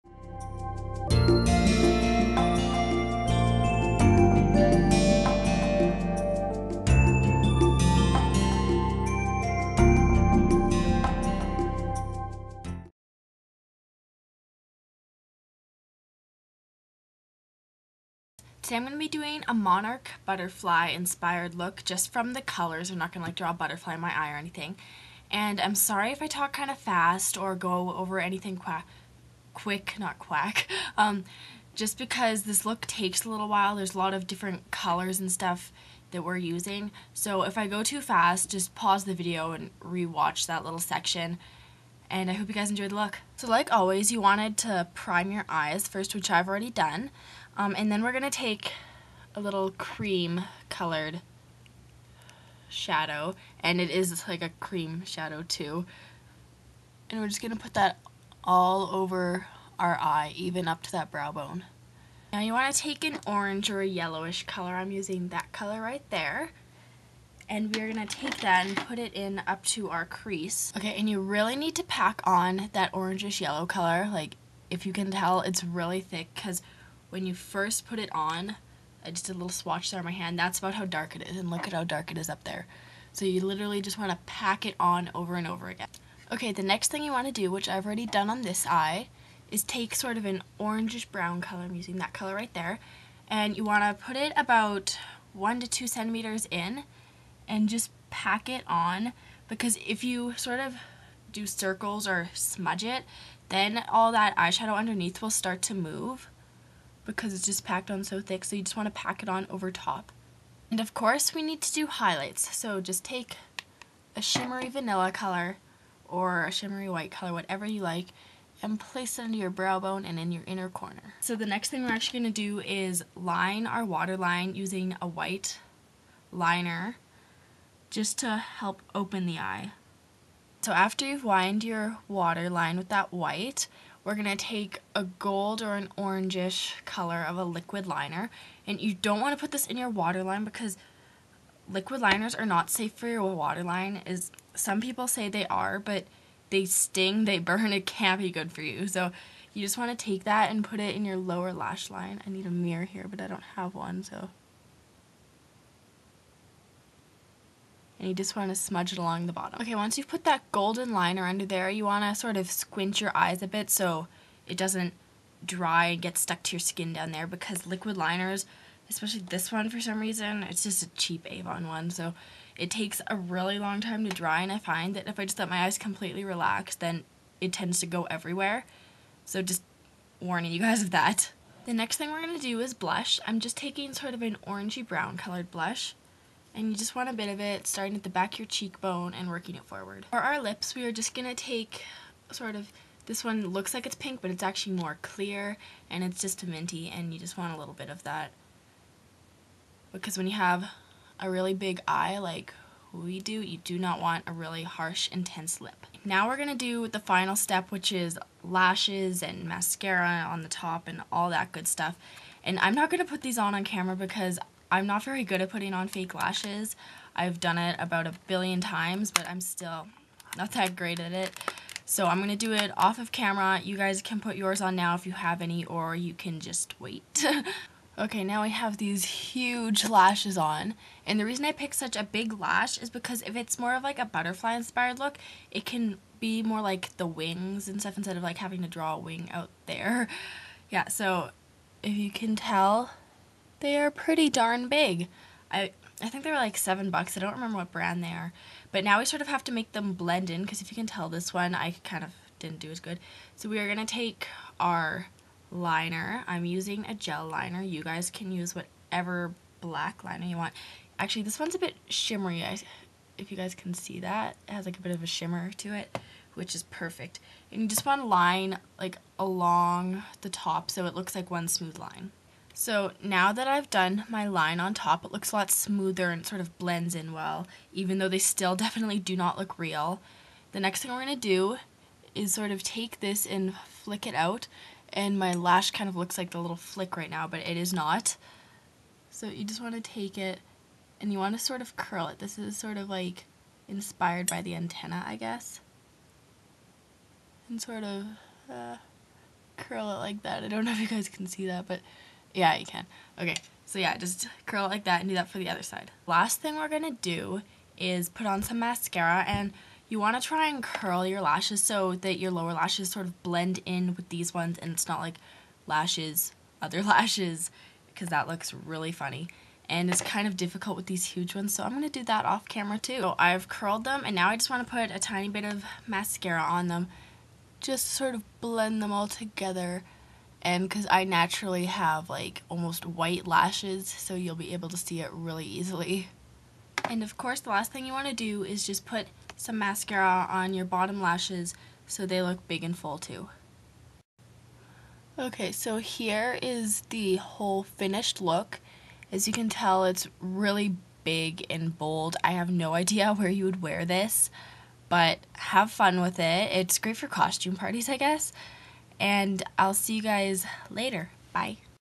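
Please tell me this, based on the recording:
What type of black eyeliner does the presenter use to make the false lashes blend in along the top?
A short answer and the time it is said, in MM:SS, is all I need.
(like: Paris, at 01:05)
Gel liner, at 04:16.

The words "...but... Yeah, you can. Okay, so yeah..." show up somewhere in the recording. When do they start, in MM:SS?
05:01.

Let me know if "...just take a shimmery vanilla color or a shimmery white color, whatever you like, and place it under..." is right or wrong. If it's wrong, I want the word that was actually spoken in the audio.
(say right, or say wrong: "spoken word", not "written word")
right.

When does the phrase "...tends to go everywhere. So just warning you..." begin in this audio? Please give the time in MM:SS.
02:57.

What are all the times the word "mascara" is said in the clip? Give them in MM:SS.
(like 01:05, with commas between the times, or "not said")
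03:29, 05:08, 05:25, 05:39.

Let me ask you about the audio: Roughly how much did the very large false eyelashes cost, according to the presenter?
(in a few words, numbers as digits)
7 bucks.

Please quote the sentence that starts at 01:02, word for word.
Now you want to take an orange or a yellowish color.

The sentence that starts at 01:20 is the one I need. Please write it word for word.
That's about how dark it is, and look at how dark it is up there.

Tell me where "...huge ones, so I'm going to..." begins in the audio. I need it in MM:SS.
05:21.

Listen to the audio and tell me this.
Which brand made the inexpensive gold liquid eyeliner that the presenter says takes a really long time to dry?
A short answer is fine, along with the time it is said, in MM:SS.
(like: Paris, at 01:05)
Avon, at 02:51.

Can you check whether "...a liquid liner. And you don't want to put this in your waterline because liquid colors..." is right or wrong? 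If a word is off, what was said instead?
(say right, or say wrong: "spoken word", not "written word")
wrong: "liners", not "colors".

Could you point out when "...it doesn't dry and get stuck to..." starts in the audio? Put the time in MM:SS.
02:44.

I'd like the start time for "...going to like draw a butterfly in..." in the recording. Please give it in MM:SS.
00:23.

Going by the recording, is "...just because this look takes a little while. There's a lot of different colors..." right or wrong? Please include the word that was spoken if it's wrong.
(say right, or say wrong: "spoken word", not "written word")
right.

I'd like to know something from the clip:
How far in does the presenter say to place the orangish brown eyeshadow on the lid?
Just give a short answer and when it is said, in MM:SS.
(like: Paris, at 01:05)
1 to 2 centimeters, at 01:35.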